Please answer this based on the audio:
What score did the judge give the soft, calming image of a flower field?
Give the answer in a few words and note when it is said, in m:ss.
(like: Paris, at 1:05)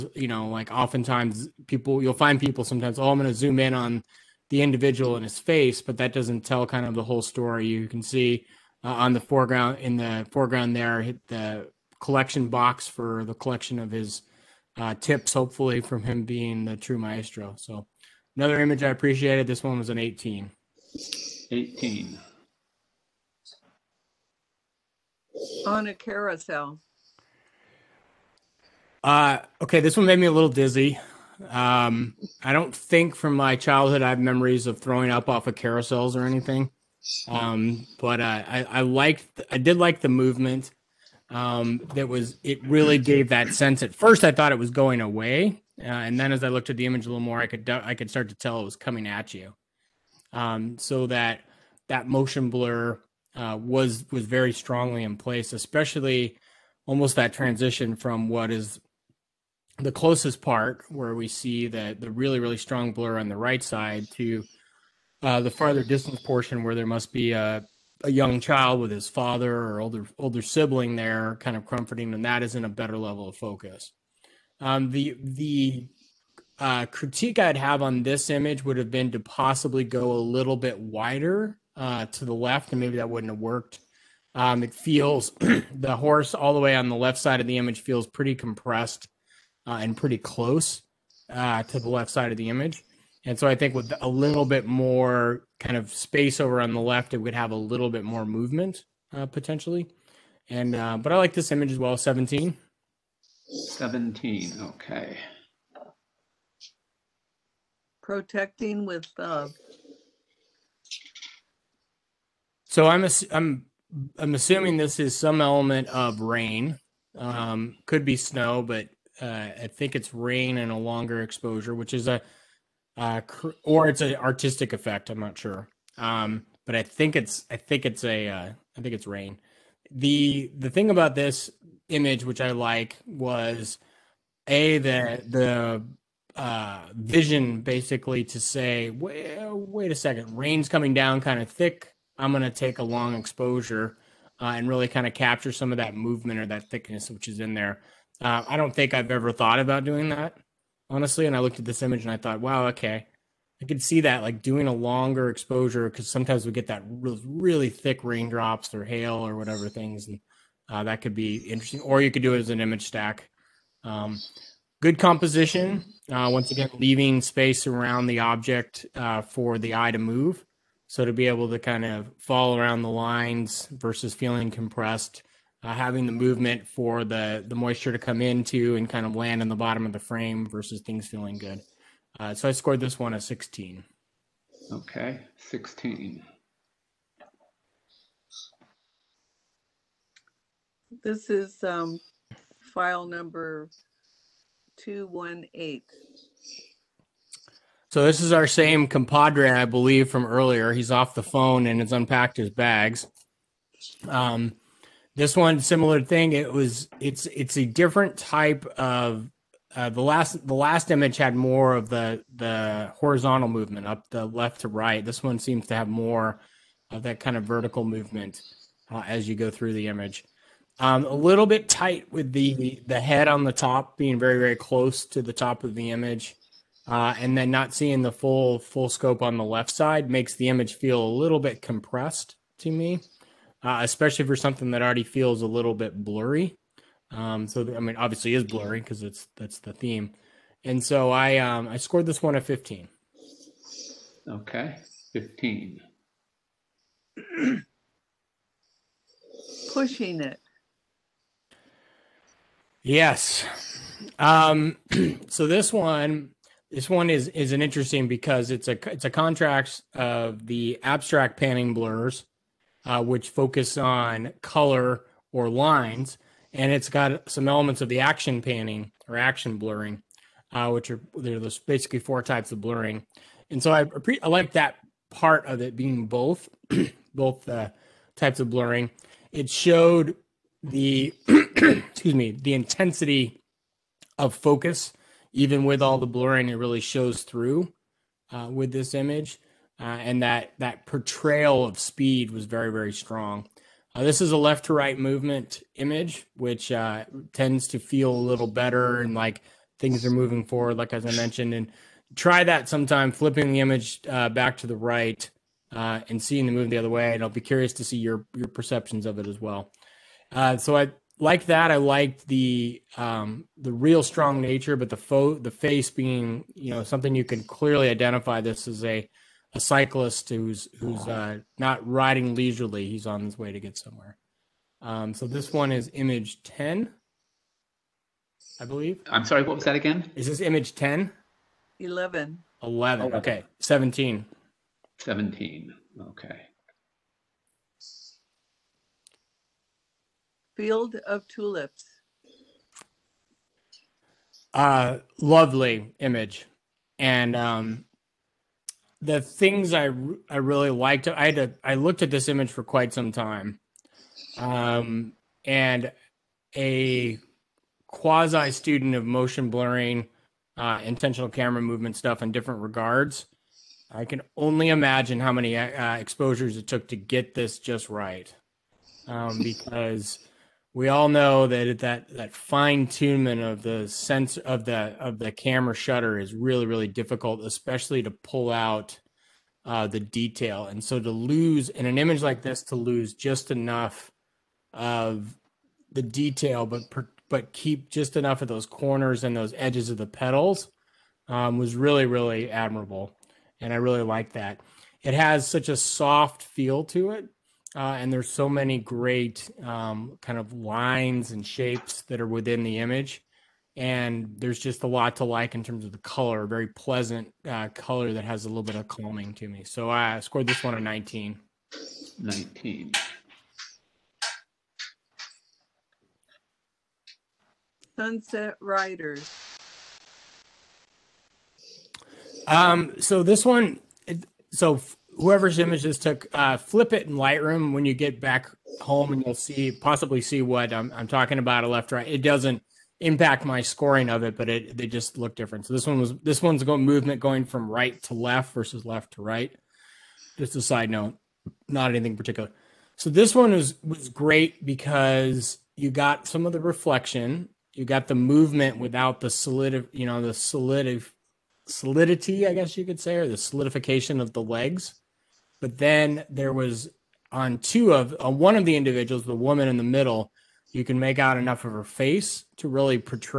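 19, at 6:50.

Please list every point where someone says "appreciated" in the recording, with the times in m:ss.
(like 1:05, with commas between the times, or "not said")
0:18.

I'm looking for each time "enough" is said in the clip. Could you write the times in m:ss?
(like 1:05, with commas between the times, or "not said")
6:23, 6:28, 7:41.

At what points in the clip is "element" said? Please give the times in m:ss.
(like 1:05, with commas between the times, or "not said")
1:55, 4:27.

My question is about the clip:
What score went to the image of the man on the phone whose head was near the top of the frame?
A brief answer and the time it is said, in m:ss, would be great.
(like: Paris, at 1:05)
15, at 4:02.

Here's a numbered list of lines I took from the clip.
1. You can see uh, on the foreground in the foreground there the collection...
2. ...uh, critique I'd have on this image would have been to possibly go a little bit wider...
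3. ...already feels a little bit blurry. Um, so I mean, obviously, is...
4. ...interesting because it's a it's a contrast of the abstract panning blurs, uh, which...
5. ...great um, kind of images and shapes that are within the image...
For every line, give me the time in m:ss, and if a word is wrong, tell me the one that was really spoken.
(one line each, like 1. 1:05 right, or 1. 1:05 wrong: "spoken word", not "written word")
1. 0:07 right
2. 1:16 right
3. 3:54 right
4. 4:17 right
5. 6:38 wrong: "lines", not "images".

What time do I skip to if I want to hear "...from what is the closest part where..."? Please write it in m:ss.
0:57.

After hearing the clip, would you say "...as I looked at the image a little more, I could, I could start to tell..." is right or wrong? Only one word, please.
right.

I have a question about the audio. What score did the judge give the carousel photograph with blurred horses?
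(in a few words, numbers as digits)
18.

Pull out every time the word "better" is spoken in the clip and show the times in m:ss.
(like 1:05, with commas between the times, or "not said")
1:12, 4:58.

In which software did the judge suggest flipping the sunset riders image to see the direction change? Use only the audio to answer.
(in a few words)
Lightroom.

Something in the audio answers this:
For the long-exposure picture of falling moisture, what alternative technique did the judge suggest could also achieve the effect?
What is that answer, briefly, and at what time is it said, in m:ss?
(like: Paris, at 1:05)
image stack, at 2:42.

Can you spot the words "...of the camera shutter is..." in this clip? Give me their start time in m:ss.
6:14.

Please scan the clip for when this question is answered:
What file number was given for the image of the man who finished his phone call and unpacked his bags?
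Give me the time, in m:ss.
3:14.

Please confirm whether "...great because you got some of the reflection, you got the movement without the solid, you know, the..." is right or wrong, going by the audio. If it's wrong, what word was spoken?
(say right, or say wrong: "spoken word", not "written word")
right.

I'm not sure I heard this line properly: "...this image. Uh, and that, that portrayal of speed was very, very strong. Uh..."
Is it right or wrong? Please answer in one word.
right.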